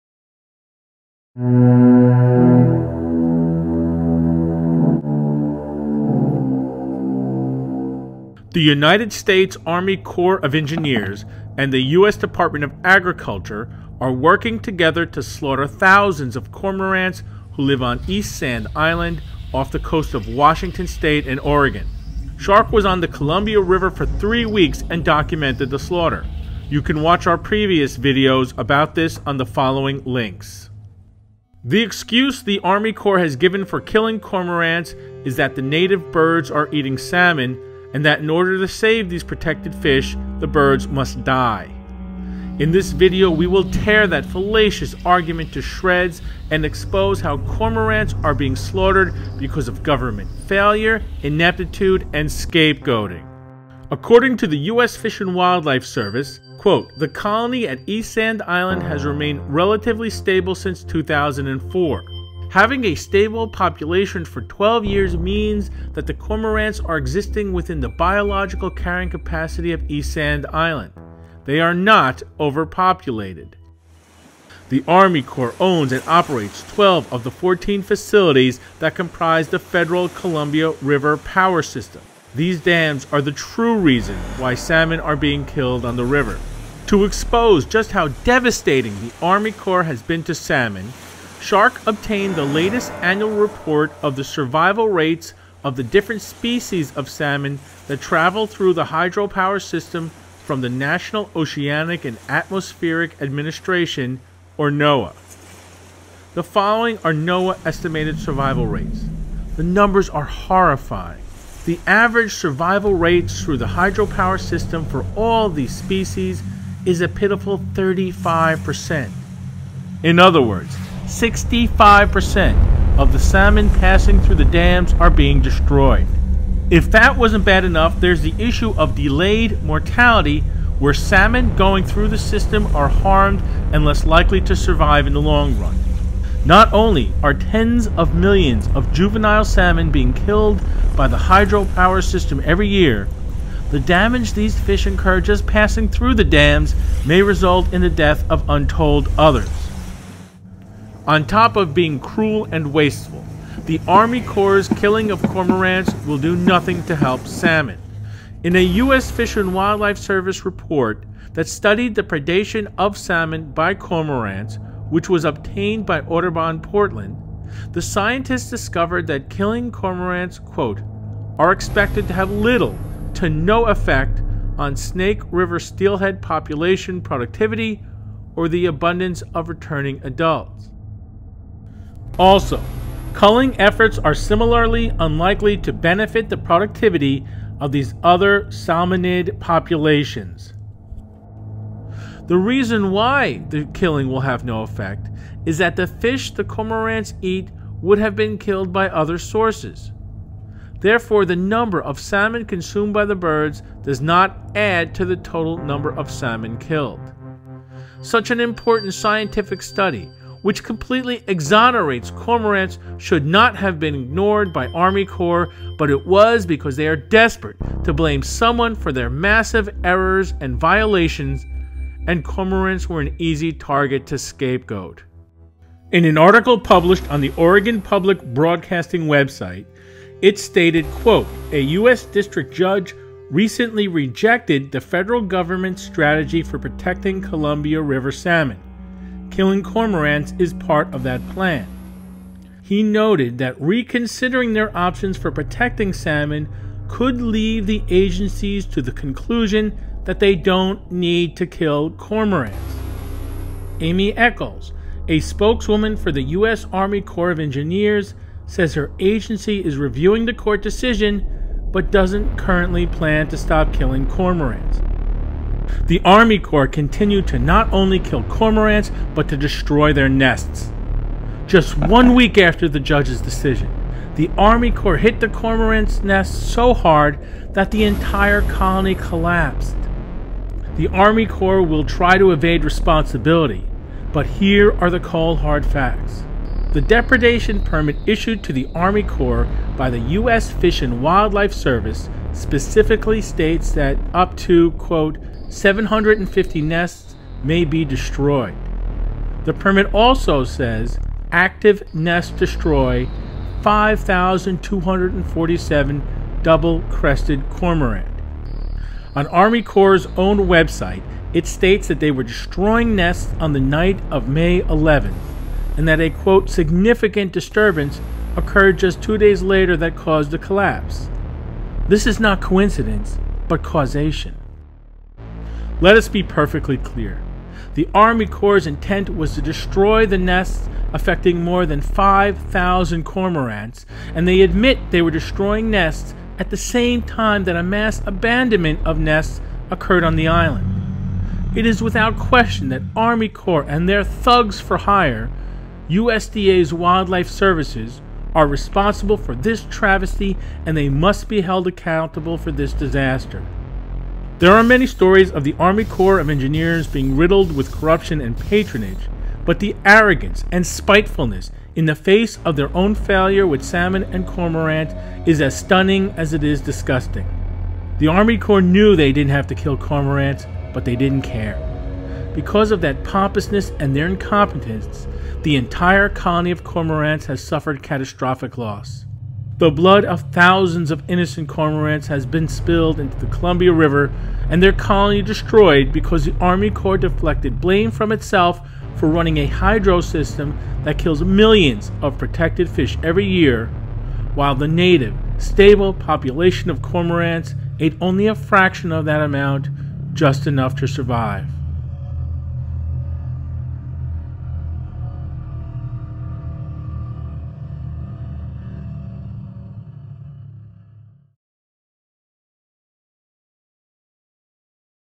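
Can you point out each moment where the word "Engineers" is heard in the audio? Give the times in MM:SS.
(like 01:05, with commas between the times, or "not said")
00:10, 04:17, 05:56.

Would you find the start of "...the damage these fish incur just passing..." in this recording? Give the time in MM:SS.
02:23.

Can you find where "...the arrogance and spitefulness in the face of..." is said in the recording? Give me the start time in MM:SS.
05:59.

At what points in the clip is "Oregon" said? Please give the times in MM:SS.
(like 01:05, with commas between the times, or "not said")
00:21, 03:47.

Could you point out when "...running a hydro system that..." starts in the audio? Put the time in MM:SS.
06:29.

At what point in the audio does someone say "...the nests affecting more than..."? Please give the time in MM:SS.
05:30.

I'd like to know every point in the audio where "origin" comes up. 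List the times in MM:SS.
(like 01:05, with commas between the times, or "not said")
not said.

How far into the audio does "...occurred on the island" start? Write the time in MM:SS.
05:39.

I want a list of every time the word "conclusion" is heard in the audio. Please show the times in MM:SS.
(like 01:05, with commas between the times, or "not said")
04:08.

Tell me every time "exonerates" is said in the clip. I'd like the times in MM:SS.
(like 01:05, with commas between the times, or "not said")
03:31.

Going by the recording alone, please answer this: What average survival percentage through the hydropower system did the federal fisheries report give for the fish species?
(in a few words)
35%.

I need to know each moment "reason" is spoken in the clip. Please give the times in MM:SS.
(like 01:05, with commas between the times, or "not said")
01:23, 03:12.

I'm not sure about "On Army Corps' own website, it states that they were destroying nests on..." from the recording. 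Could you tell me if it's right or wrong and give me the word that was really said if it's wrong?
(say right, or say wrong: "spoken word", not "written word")
right.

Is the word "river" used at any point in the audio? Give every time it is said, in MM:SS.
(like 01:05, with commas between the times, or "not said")
00:23, 01:20, 01:26, 02:55, 03:57, 06:23.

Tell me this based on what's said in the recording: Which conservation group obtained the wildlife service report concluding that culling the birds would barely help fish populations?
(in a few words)
Audubon Portland.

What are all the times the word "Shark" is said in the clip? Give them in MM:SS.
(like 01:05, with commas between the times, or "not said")
00:22, 01:31.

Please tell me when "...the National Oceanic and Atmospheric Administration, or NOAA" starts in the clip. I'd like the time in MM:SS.
01:40.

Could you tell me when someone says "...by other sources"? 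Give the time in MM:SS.
03:18.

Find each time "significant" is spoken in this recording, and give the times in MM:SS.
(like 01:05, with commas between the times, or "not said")
05:16.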